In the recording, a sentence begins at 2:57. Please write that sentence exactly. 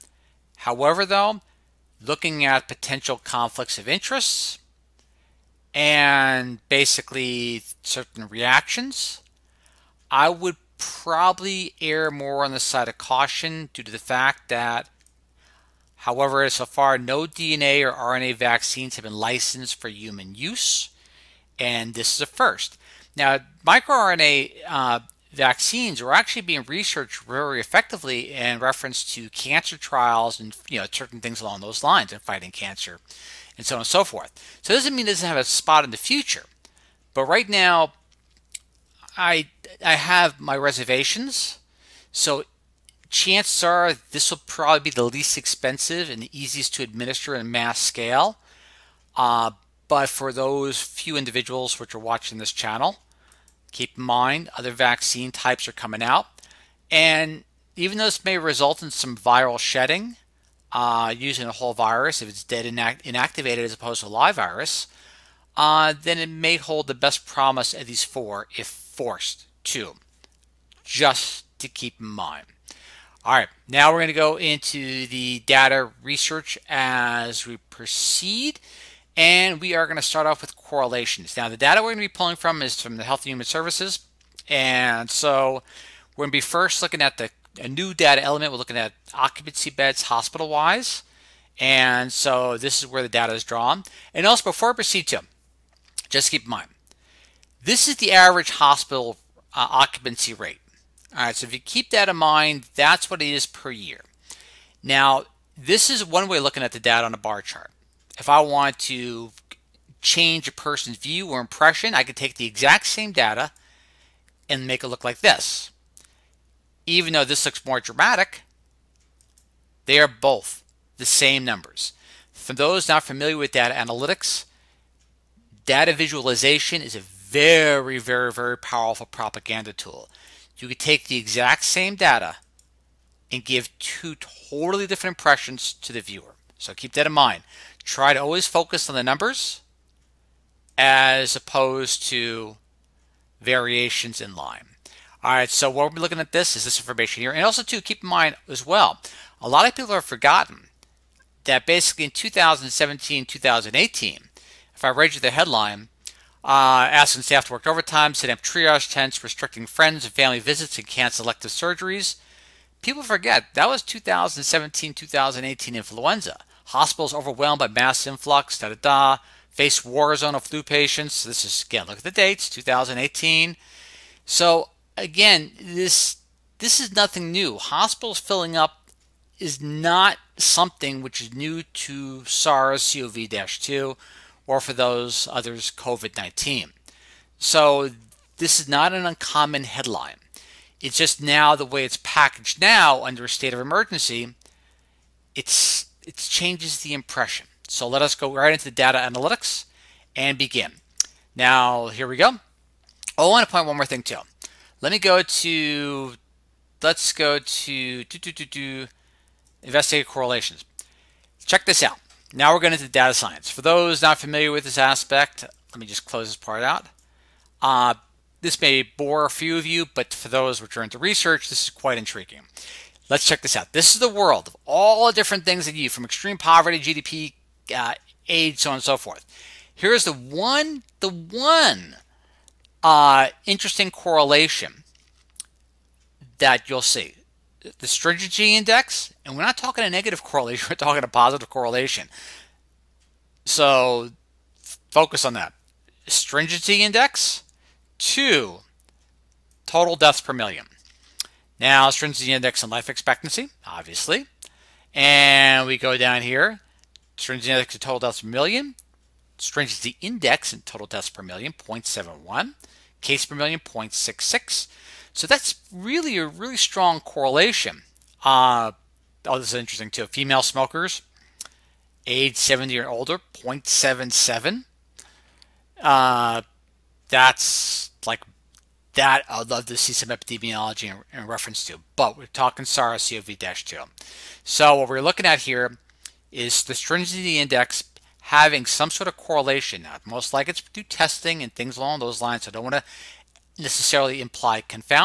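Hospitals filling up is not something which is new to SARS CoV 2 or for those others, COVID 19.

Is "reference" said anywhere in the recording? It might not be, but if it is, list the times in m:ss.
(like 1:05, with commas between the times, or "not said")
0:28, 4:41.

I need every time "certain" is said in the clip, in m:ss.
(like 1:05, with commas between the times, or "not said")
0:07, 0:30.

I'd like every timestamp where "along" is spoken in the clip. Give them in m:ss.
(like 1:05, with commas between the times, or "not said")
0:31, 4:51.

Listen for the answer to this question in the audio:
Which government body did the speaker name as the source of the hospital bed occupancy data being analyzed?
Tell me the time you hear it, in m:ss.
1:23.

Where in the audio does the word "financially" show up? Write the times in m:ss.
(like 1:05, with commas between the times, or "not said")
not said.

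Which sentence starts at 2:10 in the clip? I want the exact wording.
You could take the exact same data and give two totally different impressions to the viewer.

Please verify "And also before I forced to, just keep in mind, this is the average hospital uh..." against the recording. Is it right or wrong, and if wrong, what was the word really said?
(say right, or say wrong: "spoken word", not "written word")
wrong: "proceed", not "forced".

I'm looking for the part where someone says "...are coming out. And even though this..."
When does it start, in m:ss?
0:55.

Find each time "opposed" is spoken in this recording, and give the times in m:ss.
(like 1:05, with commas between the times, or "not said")
1:03, 2:21.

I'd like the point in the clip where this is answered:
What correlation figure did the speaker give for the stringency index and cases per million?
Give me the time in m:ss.
4:23.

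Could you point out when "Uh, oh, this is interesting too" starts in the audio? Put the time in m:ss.
4:28.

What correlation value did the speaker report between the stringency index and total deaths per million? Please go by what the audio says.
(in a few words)
0.71.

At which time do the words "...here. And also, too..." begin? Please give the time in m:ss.
2:27.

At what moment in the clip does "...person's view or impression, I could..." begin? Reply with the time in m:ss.
1:50.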